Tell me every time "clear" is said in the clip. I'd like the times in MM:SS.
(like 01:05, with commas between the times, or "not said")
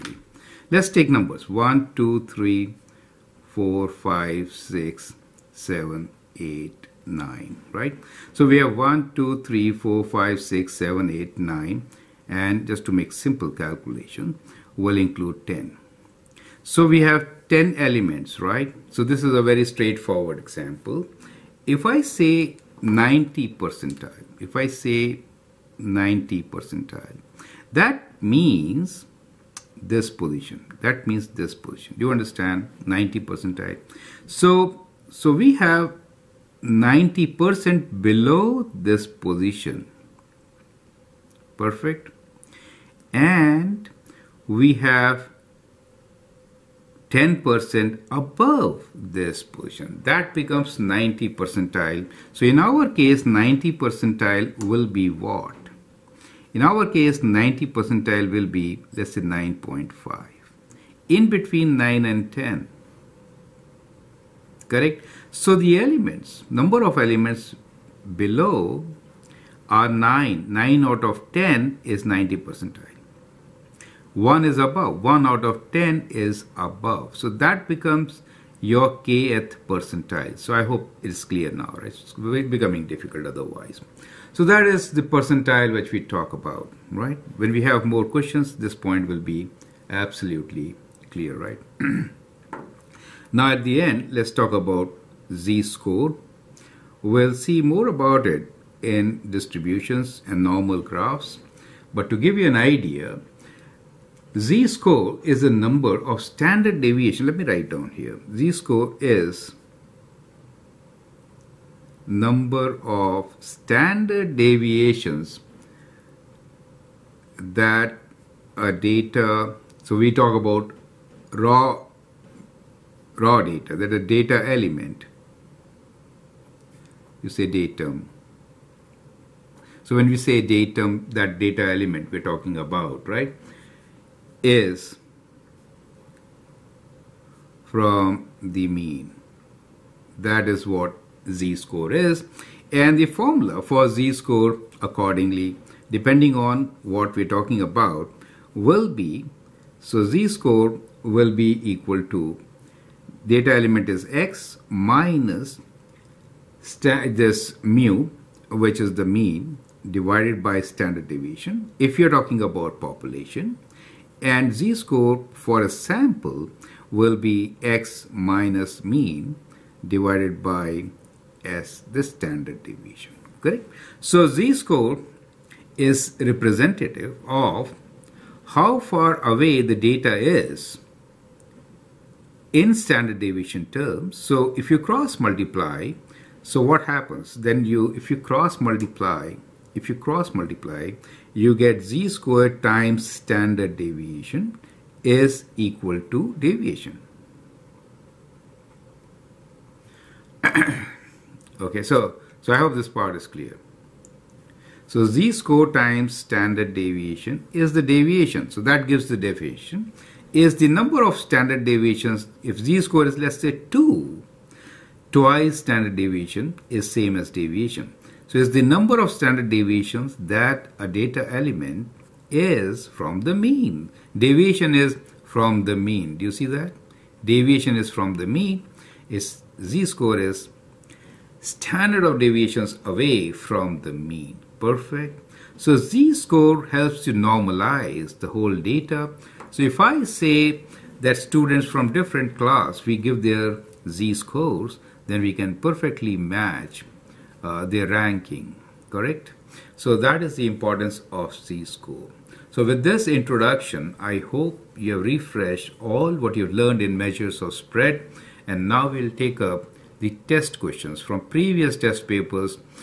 01:21, 01:31, 03:23.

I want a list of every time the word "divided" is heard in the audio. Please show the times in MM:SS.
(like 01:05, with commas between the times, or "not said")
02:39, 02:49.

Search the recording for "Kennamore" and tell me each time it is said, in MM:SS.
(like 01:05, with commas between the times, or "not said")
not said.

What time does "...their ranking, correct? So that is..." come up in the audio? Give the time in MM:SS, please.
04:07.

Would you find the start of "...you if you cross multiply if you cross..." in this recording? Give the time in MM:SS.
03:07.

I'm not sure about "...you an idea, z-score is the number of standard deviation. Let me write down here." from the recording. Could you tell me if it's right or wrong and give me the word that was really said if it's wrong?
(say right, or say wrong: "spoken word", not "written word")
right.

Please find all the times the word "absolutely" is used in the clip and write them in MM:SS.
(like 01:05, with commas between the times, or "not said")
01:29.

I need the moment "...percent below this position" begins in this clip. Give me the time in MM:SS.
00:37.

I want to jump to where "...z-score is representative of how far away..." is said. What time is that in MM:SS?
02:54.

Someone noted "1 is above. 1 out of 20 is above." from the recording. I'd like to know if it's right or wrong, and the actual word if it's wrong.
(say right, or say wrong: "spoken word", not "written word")
wrong: "10", not "20".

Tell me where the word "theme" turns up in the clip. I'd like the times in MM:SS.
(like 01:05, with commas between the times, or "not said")
not said.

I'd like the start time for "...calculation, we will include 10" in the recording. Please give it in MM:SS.
00:13.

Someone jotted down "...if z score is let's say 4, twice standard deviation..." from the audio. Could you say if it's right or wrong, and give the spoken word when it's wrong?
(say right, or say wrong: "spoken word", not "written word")
wrong: "2", not "4".